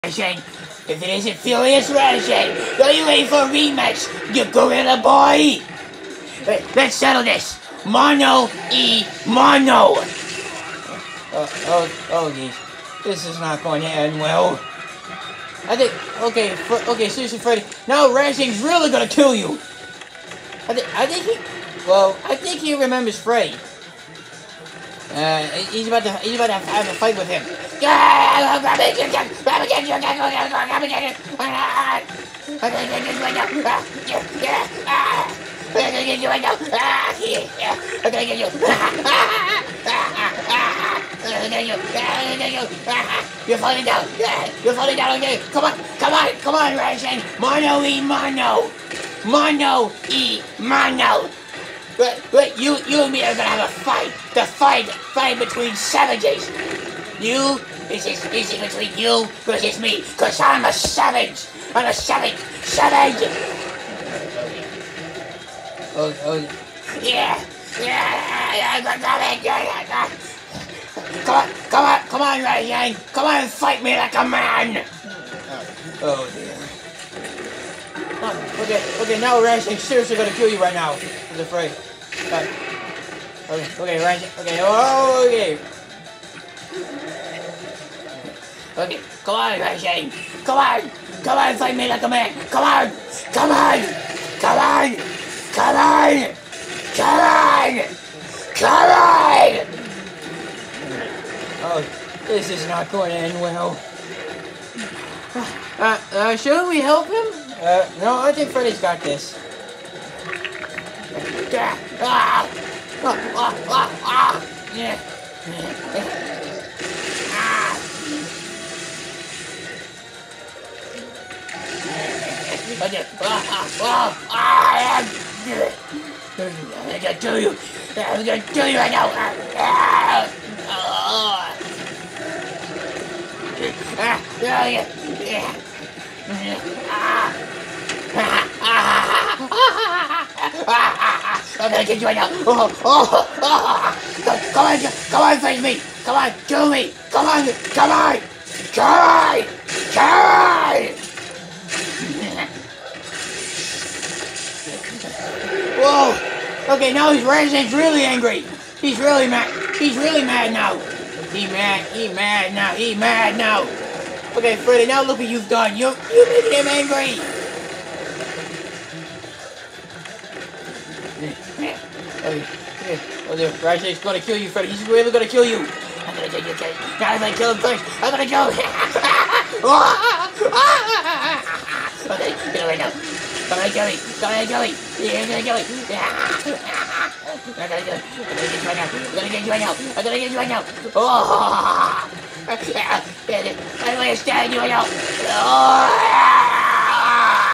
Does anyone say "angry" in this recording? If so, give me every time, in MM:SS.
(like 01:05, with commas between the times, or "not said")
02:38, 02:46.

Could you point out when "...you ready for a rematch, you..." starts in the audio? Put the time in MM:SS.
00:02.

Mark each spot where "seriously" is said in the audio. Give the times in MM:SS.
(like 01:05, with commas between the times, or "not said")
00:17, 01:19.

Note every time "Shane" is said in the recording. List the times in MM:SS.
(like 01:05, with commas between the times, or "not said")
01:29.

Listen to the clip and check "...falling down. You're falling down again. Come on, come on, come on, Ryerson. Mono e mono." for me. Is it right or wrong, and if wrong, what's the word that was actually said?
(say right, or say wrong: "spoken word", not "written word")
right.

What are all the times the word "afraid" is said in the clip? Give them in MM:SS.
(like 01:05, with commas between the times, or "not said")
01:21.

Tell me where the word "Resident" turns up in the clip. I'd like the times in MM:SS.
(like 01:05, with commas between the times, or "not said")
02:37, 02:53.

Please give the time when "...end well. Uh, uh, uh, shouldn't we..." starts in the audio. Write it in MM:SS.
01:43.